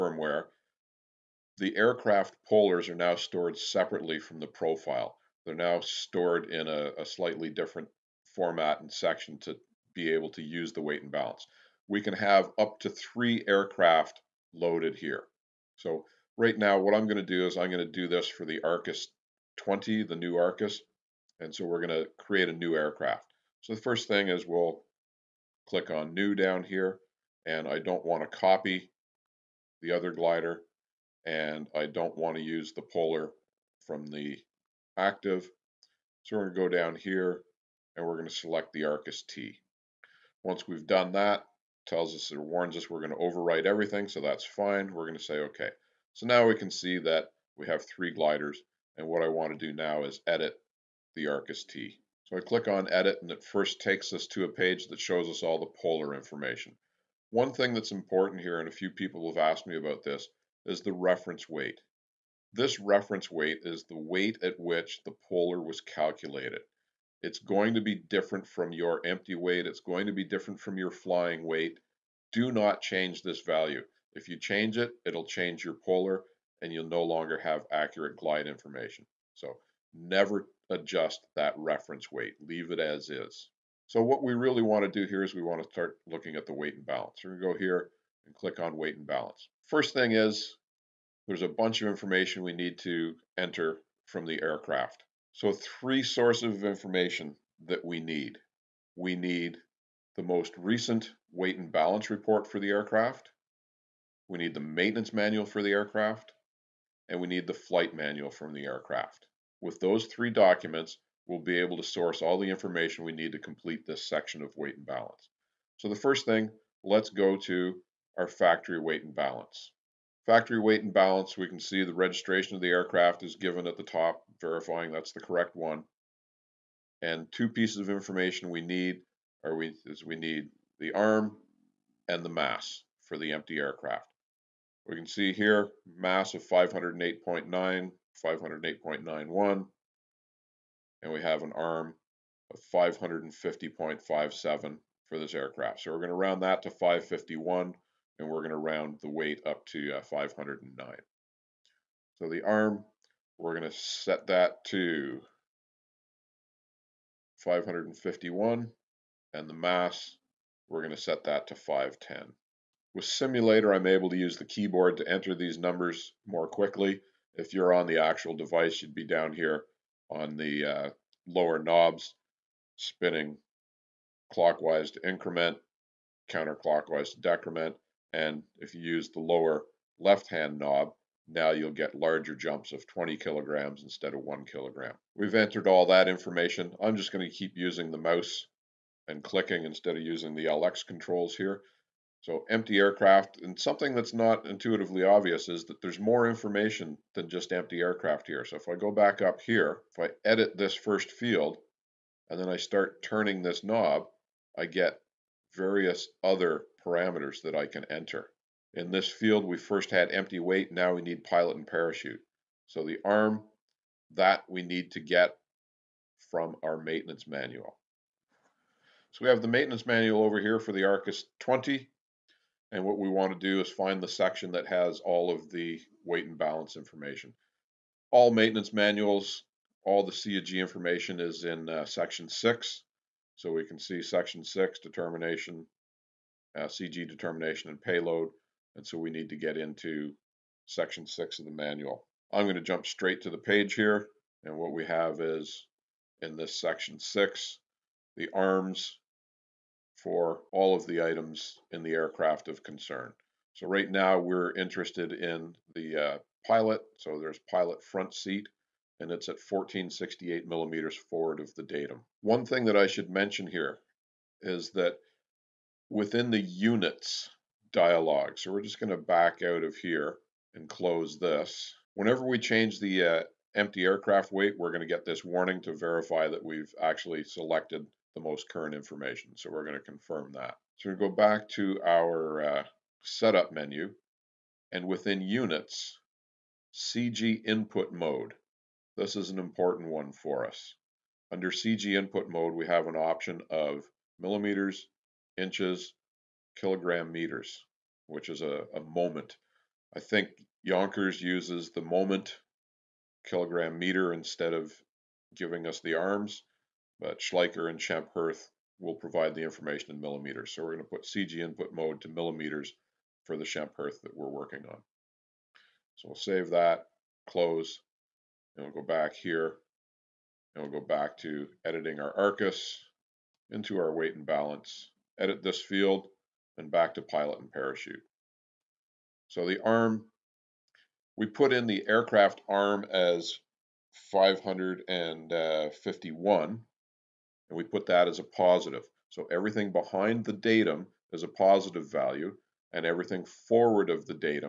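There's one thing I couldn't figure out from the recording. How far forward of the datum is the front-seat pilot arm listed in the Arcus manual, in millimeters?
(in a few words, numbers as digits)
1468.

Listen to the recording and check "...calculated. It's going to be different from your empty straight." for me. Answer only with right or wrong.
wrong.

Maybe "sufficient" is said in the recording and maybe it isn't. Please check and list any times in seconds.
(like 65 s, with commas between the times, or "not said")
not said.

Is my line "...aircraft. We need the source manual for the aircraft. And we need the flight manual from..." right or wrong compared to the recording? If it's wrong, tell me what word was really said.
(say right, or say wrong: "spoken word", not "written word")
wrong: "maintenance", not "source".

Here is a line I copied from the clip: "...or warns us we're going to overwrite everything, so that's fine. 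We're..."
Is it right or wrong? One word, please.
right.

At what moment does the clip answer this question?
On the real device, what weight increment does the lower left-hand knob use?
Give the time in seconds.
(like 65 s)
182 s.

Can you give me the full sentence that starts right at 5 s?
They're now stored in a, a, slightly different format and section to be able to use the weight and balance.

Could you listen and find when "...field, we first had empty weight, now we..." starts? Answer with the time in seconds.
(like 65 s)
209 s.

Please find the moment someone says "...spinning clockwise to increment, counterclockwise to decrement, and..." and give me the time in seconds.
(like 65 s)
172 s.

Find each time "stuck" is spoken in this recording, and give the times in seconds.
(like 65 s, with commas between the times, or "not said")
not said.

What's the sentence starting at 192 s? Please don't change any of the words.
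So empty aircraft, and something that's not intuitively obvious is that there's more information than just empty aircraft here.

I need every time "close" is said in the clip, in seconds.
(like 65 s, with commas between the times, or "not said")
270 s, 317 s.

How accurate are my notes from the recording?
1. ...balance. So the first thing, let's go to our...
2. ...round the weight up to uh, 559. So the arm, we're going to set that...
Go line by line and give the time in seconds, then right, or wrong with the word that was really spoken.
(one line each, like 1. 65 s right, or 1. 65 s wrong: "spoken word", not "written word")
1. 114 s right
2. 148 s wrong: "509", not "559".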